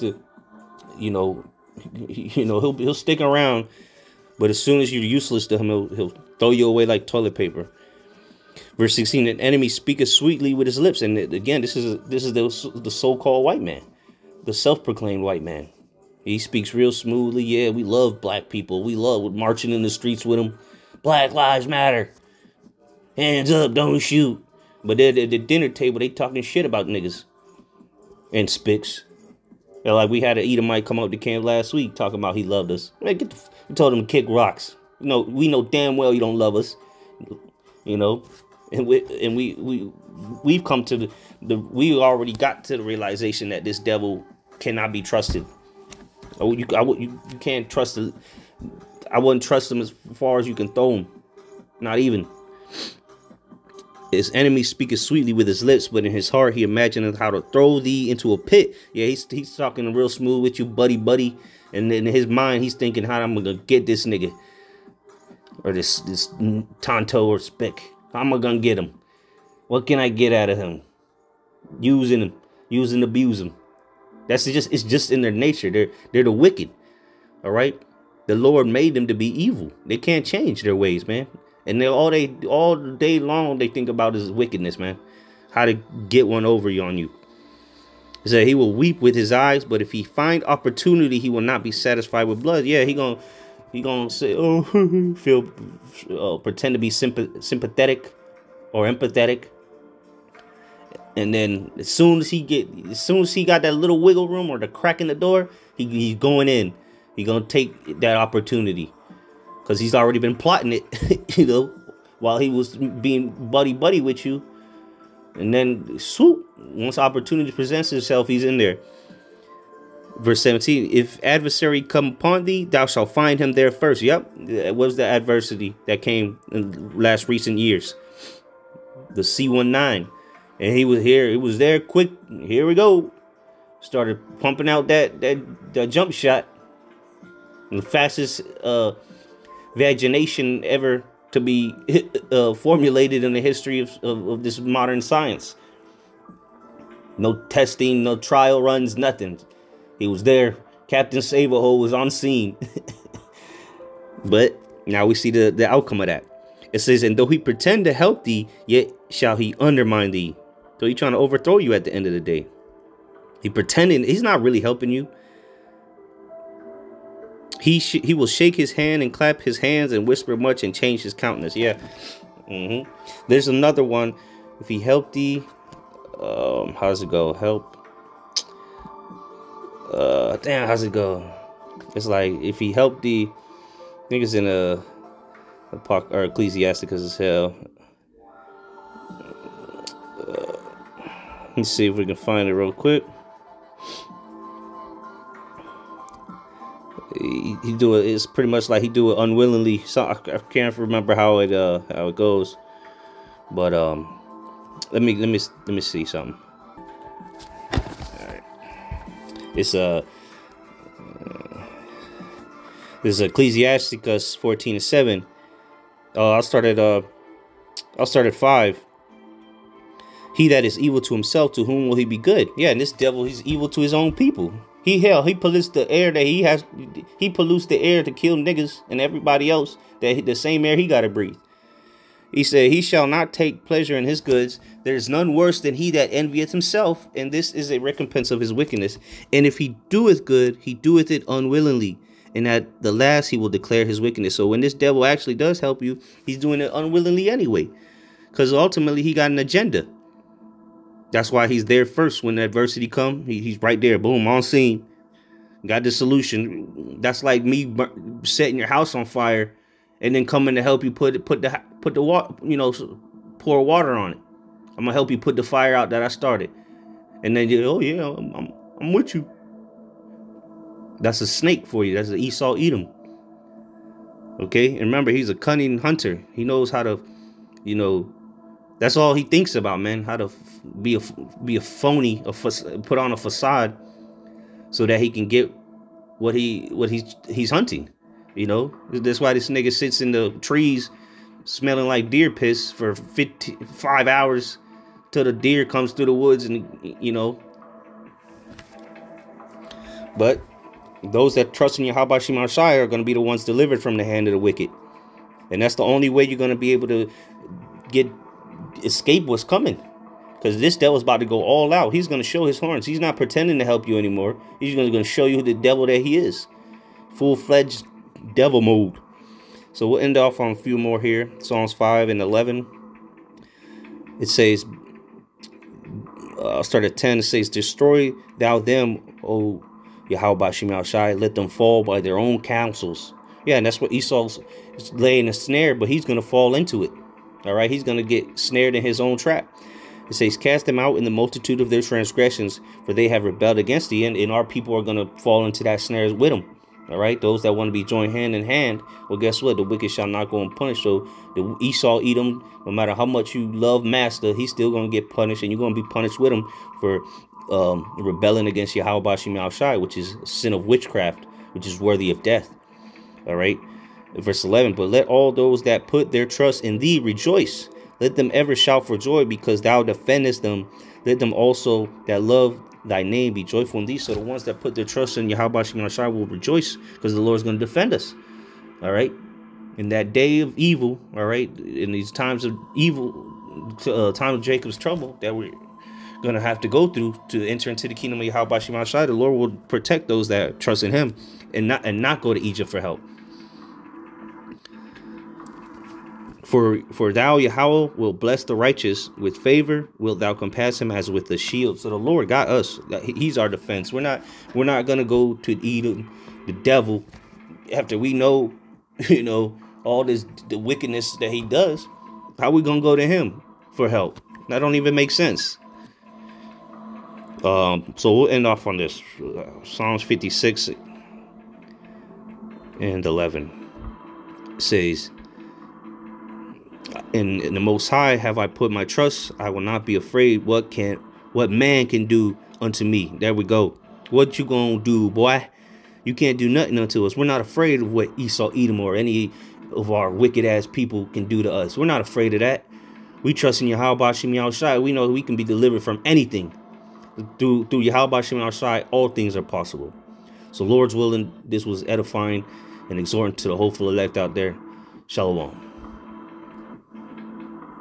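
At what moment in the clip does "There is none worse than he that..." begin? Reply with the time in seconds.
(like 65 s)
234 s.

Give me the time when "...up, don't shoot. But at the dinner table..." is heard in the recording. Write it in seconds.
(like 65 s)
23 s.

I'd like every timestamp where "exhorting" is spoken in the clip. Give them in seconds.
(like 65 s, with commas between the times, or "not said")
452 s.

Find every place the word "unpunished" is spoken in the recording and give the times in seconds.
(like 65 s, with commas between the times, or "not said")
350 s.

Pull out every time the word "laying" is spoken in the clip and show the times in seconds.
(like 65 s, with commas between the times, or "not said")
334 s.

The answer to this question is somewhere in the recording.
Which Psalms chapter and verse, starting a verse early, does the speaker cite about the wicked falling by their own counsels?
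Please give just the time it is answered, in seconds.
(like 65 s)
321 s.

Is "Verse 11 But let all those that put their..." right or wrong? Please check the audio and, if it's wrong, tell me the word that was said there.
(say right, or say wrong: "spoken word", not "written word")
right.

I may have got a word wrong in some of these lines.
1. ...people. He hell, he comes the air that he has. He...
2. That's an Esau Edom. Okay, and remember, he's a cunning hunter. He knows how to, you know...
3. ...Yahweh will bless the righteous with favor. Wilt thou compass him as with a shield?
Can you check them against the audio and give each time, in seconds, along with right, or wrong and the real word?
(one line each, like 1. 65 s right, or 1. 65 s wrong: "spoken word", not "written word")
1. 224 s wrong: "pollutes", not "comes"
2. 271 s right
3. 397 s right.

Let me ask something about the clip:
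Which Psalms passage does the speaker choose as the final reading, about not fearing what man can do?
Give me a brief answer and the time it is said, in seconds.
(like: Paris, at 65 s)
Psalms 56:11, at 419 s.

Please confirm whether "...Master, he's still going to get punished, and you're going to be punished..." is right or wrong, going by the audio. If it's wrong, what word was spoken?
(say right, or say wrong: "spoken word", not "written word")
right.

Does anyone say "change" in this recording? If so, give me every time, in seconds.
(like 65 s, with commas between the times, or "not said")
80 s, 170 s.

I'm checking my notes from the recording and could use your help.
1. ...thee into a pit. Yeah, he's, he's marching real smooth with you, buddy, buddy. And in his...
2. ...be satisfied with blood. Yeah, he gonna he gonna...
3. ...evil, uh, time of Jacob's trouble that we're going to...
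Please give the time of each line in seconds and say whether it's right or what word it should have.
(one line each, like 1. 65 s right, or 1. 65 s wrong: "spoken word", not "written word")
1. 57 s wrong: "talking", not "marching"
2. 91 s right
3. 382 s right.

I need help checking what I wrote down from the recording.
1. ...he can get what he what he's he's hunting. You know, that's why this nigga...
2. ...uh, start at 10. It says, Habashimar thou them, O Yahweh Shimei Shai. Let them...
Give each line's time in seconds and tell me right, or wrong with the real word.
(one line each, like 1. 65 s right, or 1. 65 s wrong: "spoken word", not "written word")
1. 284 s right
2. 326 s wrong: "Destroy", not "Habashimar".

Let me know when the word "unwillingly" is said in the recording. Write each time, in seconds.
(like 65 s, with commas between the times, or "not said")
199 s, 241 s, 246 s.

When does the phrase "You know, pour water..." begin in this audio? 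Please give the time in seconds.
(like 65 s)
262 s.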